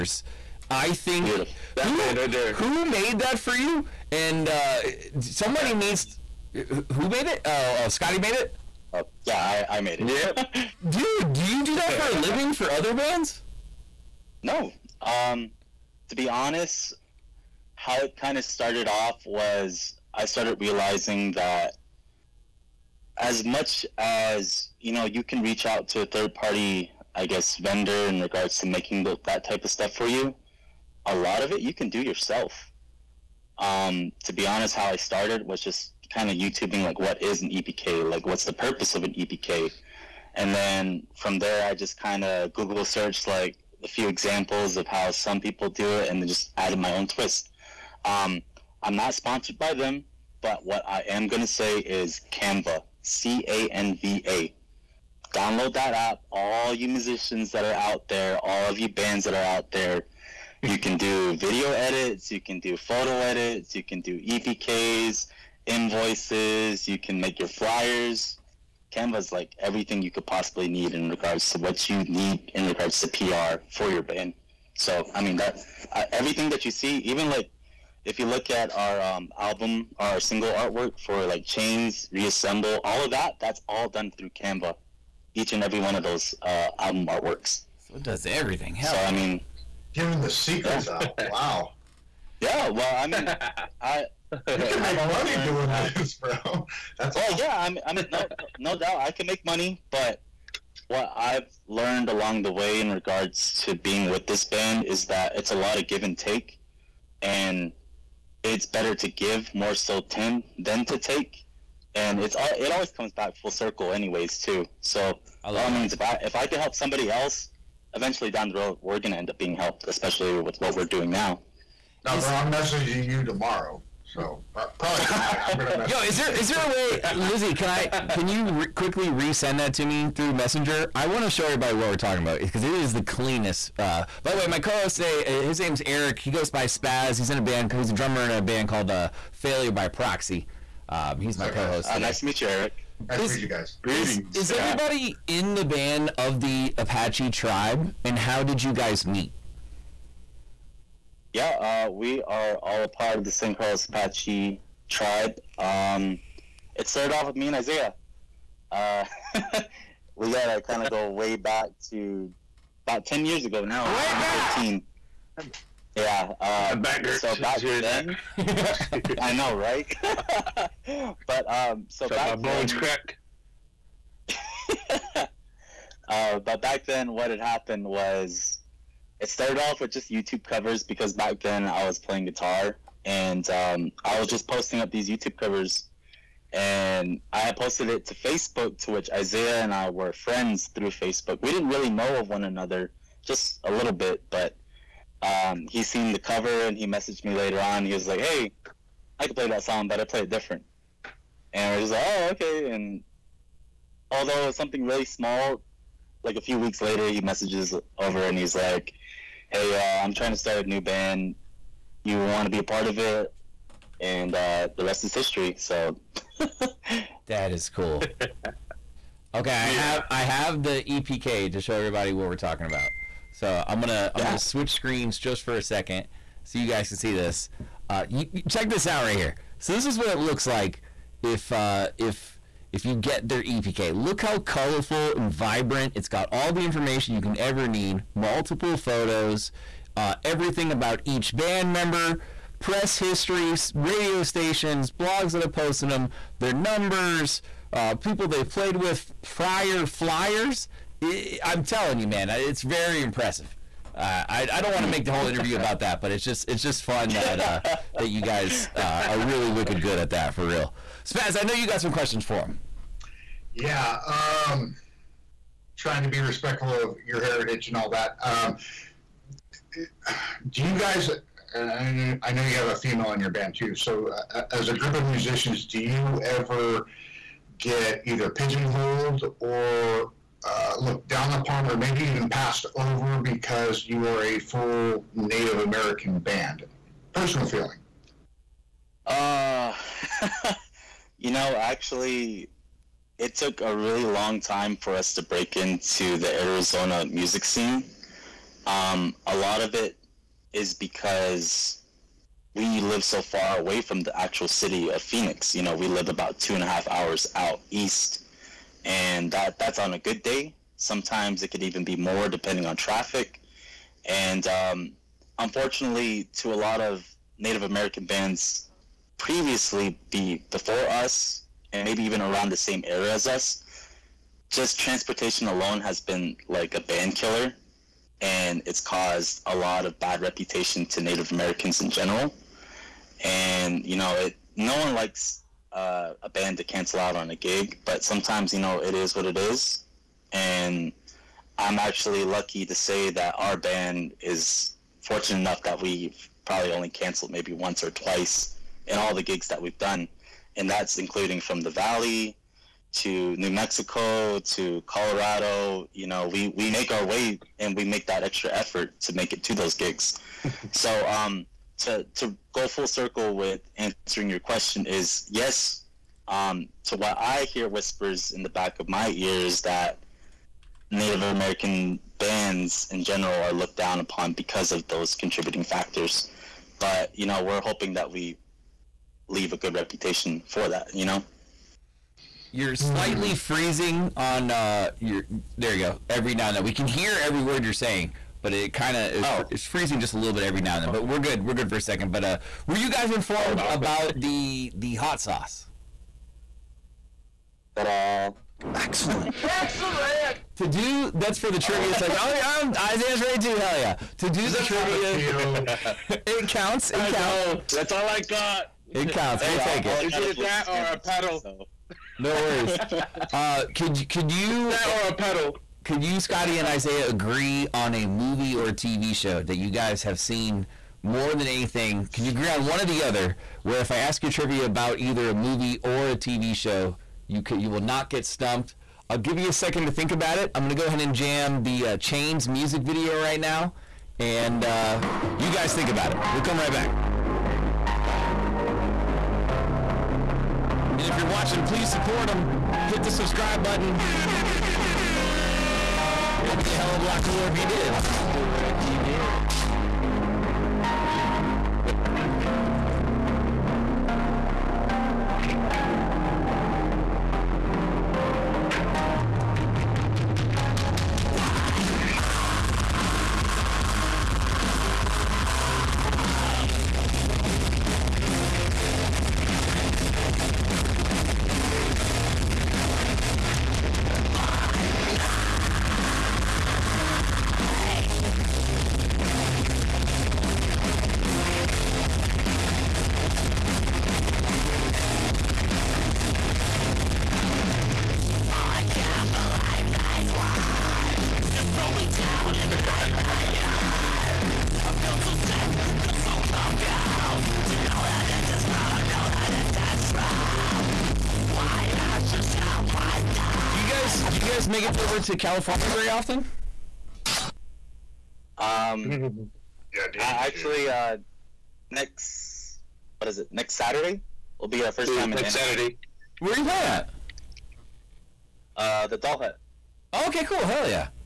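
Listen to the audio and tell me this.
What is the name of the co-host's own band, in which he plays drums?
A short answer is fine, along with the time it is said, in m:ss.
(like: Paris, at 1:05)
Failure by Proxy, at 2:19.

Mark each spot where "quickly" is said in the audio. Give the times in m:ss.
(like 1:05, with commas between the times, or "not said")
2:08.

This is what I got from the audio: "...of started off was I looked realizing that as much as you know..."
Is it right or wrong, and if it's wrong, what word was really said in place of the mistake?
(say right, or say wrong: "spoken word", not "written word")
wrong: "started", not "looked".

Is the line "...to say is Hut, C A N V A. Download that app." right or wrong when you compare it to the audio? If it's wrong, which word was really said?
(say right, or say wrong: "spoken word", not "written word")
wrong: "Canva", not "Hut".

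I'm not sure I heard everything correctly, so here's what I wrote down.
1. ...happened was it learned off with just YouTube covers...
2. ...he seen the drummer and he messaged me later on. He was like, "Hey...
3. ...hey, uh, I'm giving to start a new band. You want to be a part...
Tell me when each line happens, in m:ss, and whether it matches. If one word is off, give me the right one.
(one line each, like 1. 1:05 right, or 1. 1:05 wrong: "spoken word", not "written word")
1. 2:57 wrong: "started", not "learned"
2. 3:15 wrong: "cover", not "drummer"
3. 3:29 wrong: "trying", not "giving".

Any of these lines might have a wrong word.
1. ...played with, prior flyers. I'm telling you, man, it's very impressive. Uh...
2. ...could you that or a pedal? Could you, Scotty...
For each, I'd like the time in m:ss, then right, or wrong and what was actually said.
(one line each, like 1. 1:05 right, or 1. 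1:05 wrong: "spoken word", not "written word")
1. 4:08 right
2. 6:54 right.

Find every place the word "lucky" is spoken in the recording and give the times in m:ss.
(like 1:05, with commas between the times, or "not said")
5:42.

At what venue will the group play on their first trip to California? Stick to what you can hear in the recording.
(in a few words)
The Doll Hut.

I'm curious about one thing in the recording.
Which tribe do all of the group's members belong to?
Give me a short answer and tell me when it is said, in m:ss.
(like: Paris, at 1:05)
San Carlos Apache, at 2:33.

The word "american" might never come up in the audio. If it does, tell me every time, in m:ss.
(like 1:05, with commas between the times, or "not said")
4:45, 5:17, 5:31, 6:11.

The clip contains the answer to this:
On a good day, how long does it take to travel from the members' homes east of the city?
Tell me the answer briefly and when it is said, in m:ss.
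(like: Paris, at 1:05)
2 and a half hours, at 5:06.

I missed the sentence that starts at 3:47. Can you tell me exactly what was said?
Uh, you, you check this out right here.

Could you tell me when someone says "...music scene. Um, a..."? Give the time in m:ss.
4:57.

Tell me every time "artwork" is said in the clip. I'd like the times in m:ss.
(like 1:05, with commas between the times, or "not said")
1:20, 1:27.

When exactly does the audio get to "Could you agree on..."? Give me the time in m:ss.
7:02.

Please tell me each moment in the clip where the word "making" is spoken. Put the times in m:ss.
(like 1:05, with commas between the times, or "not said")
0:28.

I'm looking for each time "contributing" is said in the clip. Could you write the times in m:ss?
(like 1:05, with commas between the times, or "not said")
6:15.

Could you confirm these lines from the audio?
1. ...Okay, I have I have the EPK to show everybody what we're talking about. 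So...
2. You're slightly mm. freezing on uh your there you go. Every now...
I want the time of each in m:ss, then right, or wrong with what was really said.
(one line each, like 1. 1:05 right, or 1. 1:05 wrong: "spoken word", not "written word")
1. 3:39 right
2. 6:22 right.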